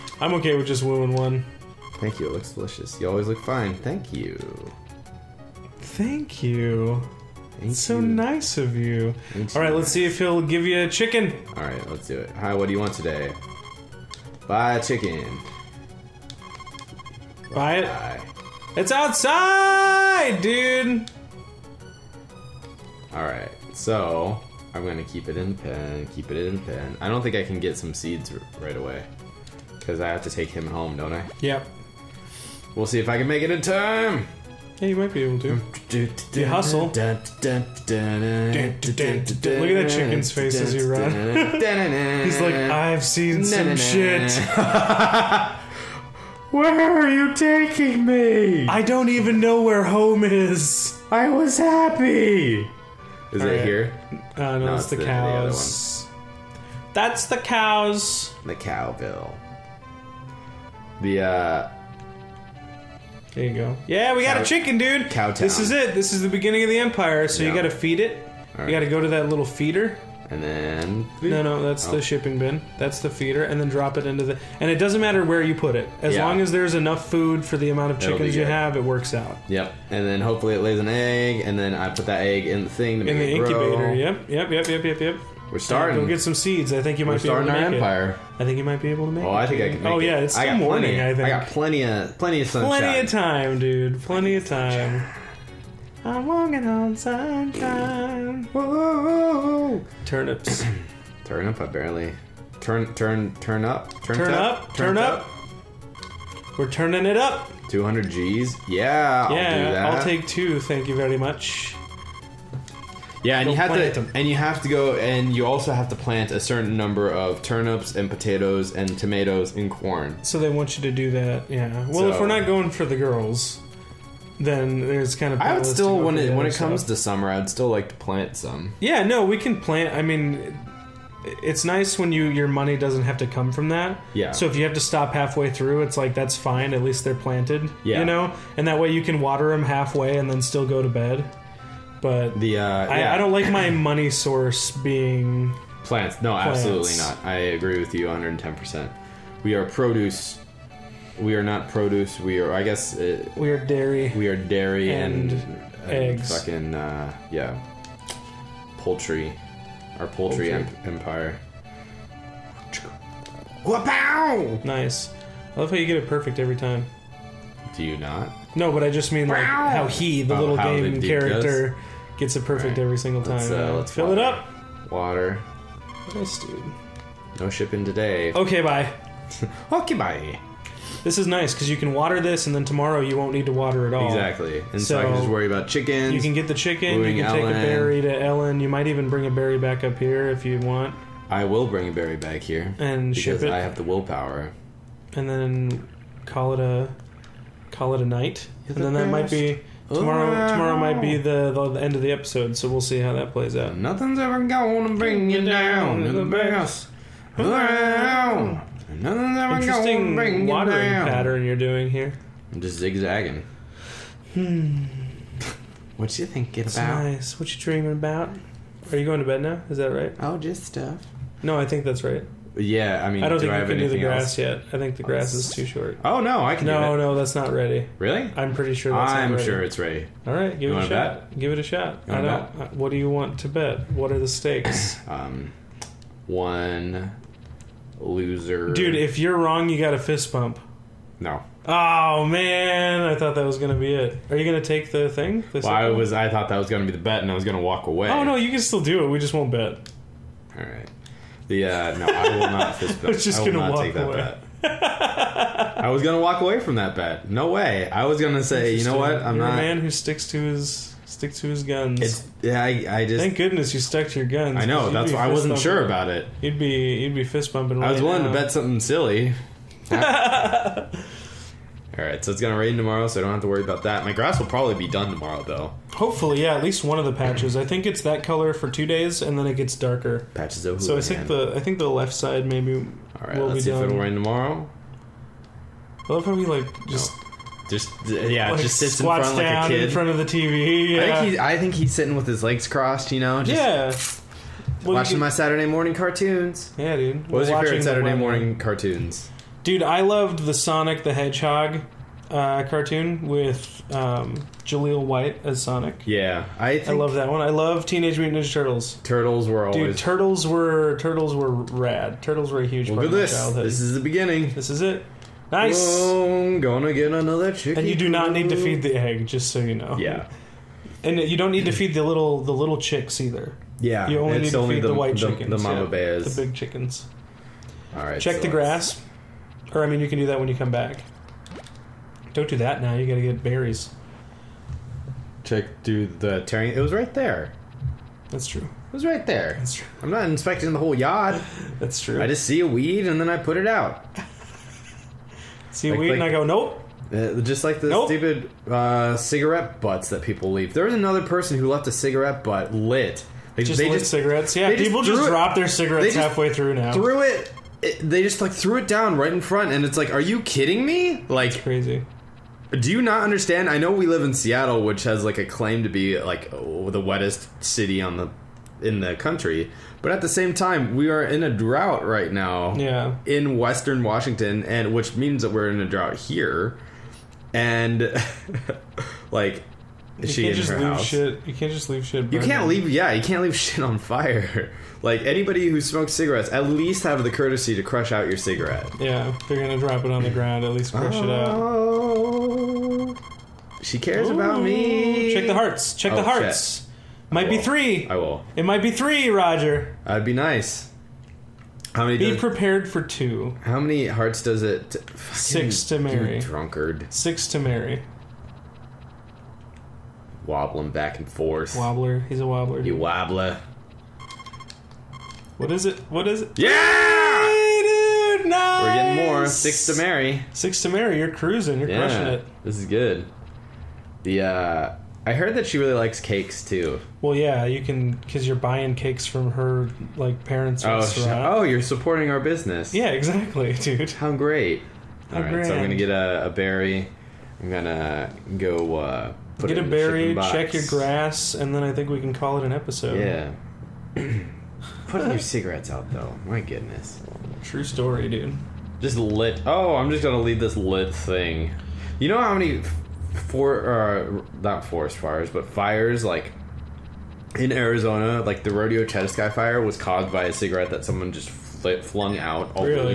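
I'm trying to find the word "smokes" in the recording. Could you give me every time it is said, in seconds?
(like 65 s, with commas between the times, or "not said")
385 s.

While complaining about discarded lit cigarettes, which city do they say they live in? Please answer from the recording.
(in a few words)
Seattle.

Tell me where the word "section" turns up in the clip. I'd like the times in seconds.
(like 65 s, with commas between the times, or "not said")
not said.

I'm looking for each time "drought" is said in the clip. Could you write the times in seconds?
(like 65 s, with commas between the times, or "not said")
371 s, 375 s.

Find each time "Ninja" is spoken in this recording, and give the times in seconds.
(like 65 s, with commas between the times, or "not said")
308 s.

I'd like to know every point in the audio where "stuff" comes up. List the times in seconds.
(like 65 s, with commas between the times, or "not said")
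126 s, 220 s.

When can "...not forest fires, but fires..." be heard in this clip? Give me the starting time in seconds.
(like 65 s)
454 s.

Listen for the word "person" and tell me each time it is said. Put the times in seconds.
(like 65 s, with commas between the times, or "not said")
351 s.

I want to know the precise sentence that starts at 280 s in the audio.
Patches of So I think the I think the left side maybe All right, will let's see if it'll rain tomorrow.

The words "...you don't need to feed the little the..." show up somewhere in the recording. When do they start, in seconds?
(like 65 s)
321 s.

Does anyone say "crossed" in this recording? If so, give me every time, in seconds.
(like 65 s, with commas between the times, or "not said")
292 s.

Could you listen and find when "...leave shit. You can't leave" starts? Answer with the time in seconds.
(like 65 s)
381 s.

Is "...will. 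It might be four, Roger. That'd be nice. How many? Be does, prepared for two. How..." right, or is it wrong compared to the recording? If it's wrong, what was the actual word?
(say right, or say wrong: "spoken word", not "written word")
wrong: "three", not "four".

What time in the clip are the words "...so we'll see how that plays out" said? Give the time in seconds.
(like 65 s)
202 s.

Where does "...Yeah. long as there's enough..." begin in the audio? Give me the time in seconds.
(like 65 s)
76 s.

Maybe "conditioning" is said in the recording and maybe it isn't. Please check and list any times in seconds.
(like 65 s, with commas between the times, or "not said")
not said.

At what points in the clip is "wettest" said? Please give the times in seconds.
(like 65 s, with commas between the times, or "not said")
367 s.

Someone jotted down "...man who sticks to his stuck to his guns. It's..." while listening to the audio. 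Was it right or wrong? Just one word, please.
wrong.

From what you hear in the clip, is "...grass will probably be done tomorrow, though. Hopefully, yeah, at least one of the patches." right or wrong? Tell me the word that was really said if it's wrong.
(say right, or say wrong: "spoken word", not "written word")
right.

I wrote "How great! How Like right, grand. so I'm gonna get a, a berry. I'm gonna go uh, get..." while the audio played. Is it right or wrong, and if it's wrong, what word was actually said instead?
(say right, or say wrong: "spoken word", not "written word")
wrong: "All", not "Like".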